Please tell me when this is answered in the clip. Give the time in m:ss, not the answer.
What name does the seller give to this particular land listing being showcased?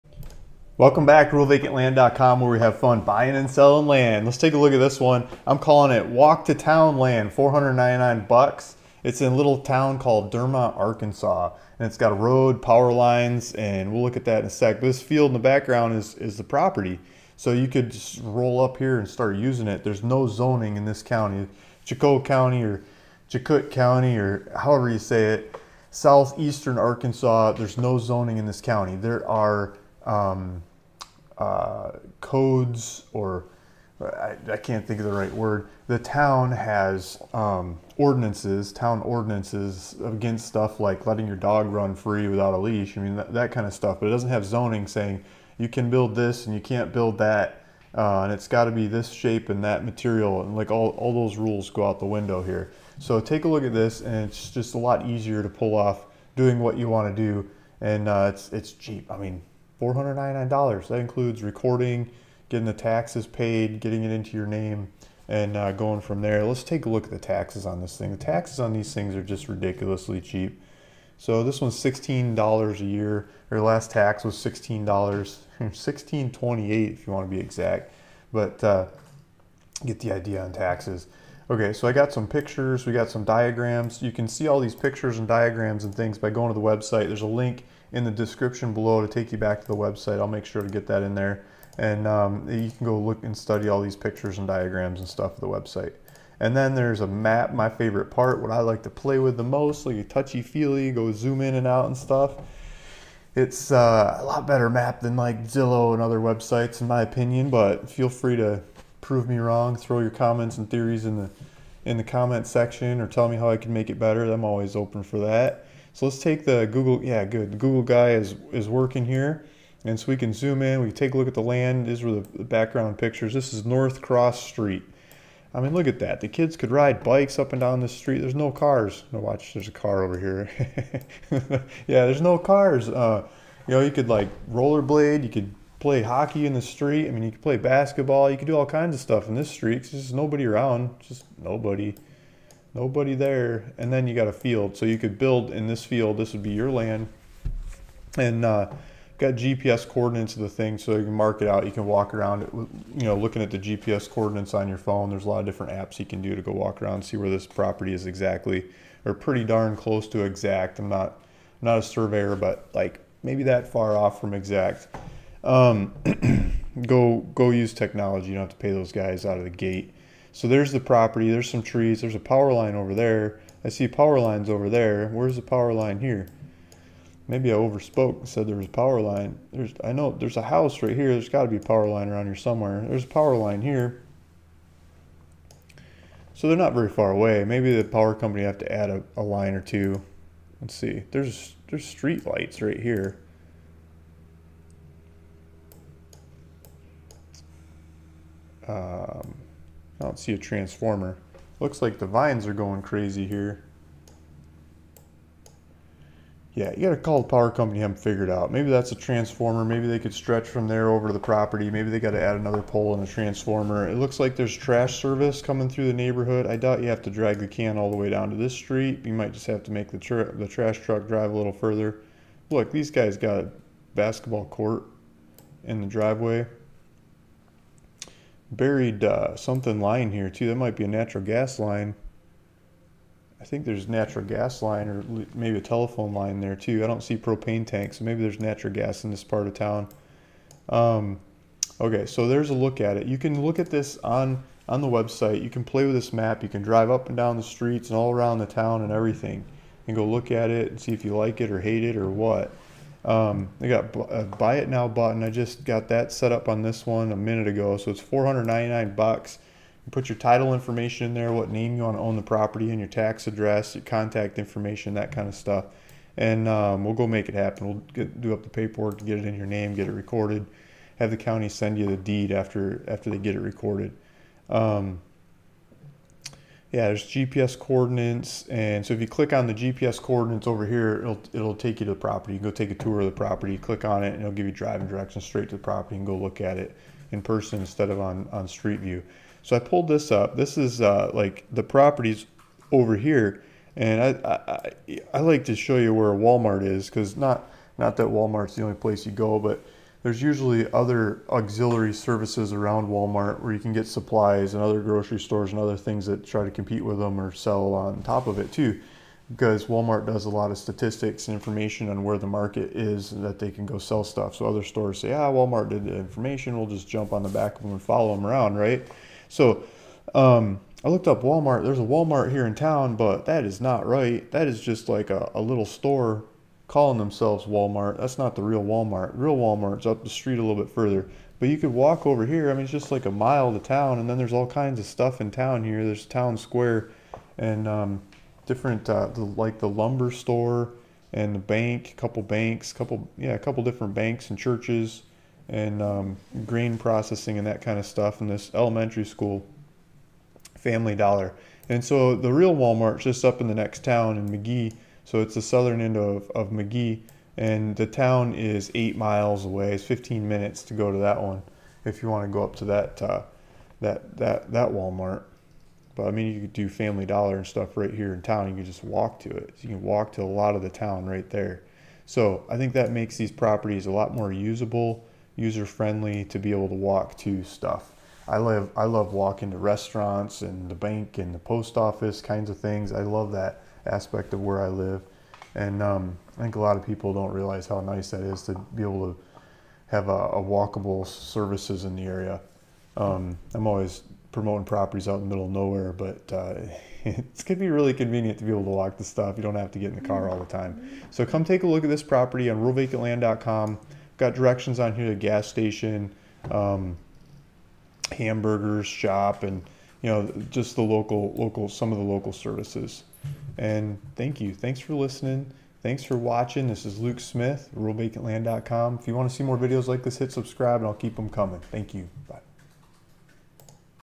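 0:06.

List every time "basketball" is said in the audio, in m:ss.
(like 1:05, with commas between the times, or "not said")
2:17, 3:43.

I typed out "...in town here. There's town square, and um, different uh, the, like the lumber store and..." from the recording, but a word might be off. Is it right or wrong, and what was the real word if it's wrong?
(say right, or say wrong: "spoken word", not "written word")
right.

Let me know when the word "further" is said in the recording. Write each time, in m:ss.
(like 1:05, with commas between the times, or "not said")
3:41, 5:30.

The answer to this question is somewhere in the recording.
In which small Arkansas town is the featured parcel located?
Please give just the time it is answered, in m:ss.
0:10.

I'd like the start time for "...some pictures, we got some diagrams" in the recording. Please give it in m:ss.
1:22.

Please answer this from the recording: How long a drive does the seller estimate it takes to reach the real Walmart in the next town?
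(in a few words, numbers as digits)
15 minutes.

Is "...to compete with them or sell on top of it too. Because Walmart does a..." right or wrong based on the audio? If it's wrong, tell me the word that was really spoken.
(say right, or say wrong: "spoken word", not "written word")
right.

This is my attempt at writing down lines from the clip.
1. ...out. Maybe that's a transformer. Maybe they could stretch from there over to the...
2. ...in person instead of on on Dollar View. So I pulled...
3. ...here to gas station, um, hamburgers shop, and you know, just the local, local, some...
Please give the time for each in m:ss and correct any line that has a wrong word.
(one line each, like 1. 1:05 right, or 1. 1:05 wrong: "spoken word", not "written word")
1. 3:28 right
2. 4:47 wrong: "Street", not "Dollar"
3. 6:44 right.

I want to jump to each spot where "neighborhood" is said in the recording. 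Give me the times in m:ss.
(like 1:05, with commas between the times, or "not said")
3:35.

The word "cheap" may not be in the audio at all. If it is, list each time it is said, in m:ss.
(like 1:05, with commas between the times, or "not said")
0:58, 1:10.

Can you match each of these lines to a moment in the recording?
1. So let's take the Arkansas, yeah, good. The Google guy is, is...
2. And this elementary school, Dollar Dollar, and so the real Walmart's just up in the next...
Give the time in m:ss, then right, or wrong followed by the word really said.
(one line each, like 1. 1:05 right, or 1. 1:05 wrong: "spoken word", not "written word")
1. 1:55 wrong: "Google", not "Arkansas"
2. 5:48 wrong: "Family", not "Dollar".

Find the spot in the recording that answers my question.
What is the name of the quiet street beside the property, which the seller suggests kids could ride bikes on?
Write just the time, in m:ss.
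2:03.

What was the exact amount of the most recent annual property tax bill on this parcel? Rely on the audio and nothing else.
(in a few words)
$16.28.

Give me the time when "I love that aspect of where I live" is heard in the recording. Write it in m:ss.
6:22.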